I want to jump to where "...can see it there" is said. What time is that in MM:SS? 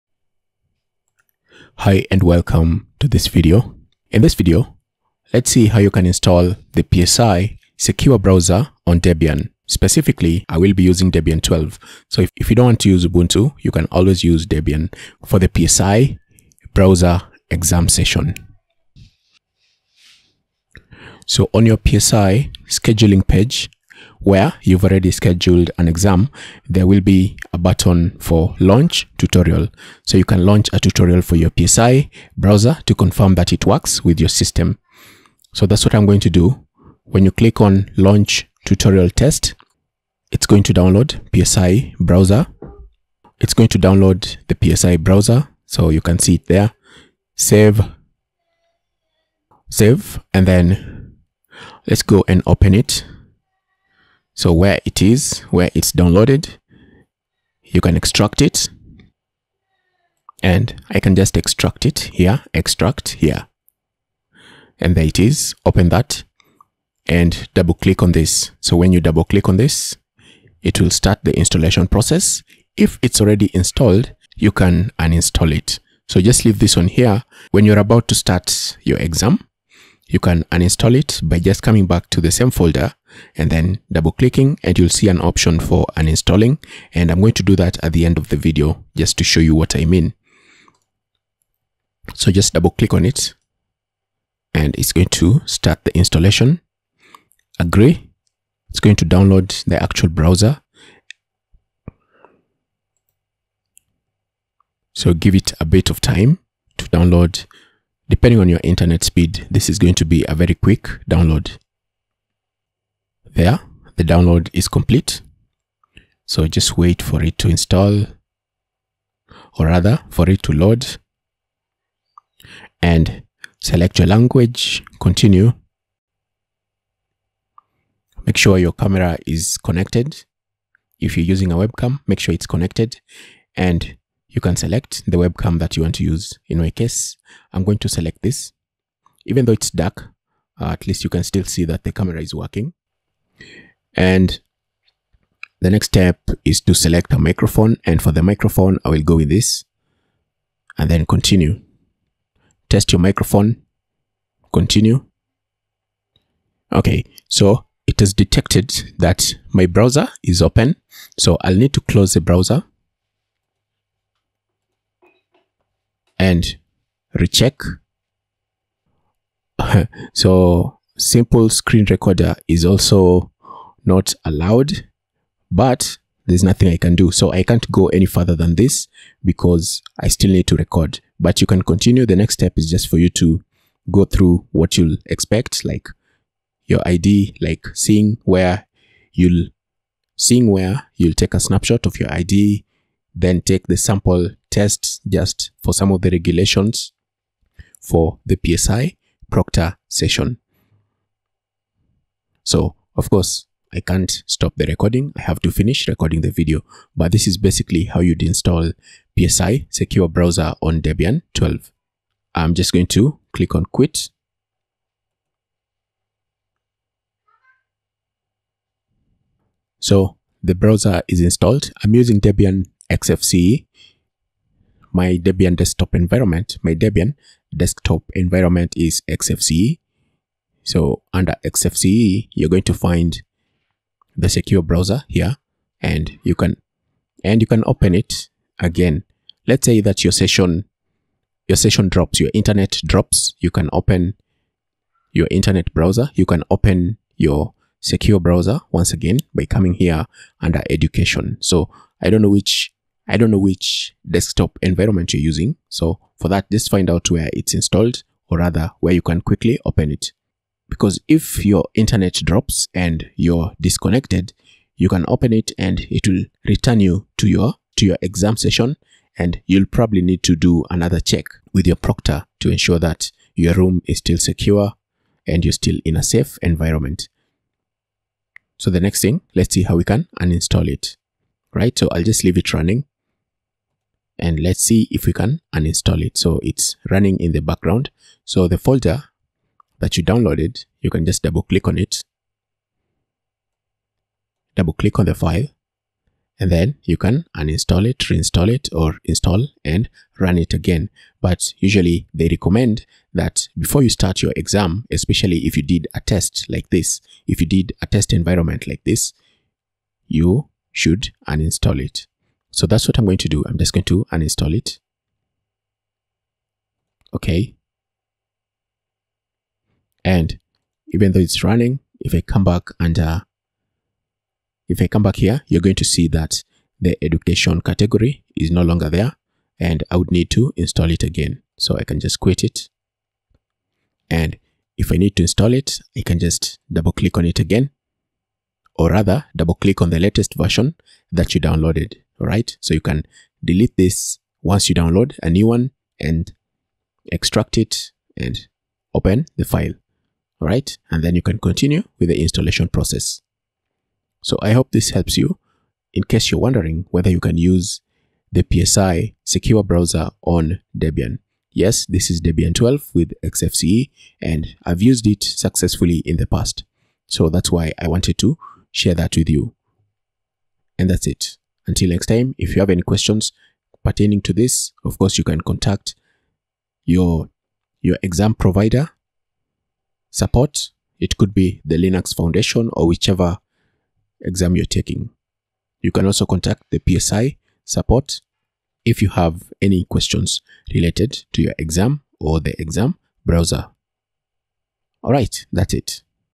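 00:46.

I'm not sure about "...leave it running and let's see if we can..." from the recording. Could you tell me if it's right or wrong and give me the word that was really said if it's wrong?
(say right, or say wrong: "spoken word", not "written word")
right.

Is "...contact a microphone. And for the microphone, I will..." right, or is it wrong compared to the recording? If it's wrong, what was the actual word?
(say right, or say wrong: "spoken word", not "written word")
wrong: "select", not "contact".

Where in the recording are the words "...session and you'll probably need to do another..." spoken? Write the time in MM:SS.
04:28.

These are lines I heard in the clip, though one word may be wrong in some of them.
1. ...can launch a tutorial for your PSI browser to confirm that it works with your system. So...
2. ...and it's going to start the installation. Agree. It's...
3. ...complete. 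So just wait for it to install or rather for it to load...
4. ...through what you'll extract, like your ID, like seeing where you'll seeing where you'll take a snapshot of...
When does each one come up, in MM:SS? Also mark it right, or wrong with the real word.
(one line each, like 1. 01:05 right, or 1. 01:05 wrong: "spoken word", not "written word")
1. 00:30 right
2. 01:34 right
3. 01:54 right
4. 03:04 wrong: "expect", not "extract".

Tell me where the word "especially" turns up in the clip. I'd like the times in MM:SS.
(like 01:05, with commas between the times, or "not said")
05:04.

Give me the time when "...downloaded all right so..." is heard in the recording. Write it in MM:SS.
05:41.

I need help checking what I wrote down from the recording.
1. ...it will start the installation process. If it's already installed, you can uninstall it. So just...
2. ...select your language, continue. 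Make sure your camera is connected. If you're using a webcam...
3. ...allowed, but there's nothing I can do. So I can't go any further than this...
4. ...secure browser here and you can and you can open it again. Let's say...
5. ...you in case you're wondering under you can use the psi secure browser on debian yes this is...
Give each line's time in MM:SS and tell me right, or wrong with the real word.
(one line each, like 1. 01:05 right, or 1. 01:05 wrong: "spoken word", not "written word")
1. 01:10 right
2. 02:03 right
3. 02:54 right
4. 03:54 right
5. 05:55 wrong: "whether", not "under".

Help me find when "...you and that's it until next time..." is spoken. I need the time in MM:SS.
06:09.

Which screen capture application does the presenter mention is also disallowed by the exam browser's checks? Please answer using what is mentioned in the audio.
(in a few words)
Simple Screen Recorder.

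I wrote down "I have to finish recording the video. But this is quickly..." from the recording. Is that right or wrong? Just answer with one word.
wrong.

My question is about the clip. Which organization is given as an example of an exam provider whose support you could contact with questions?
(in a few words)
Linux Foundation.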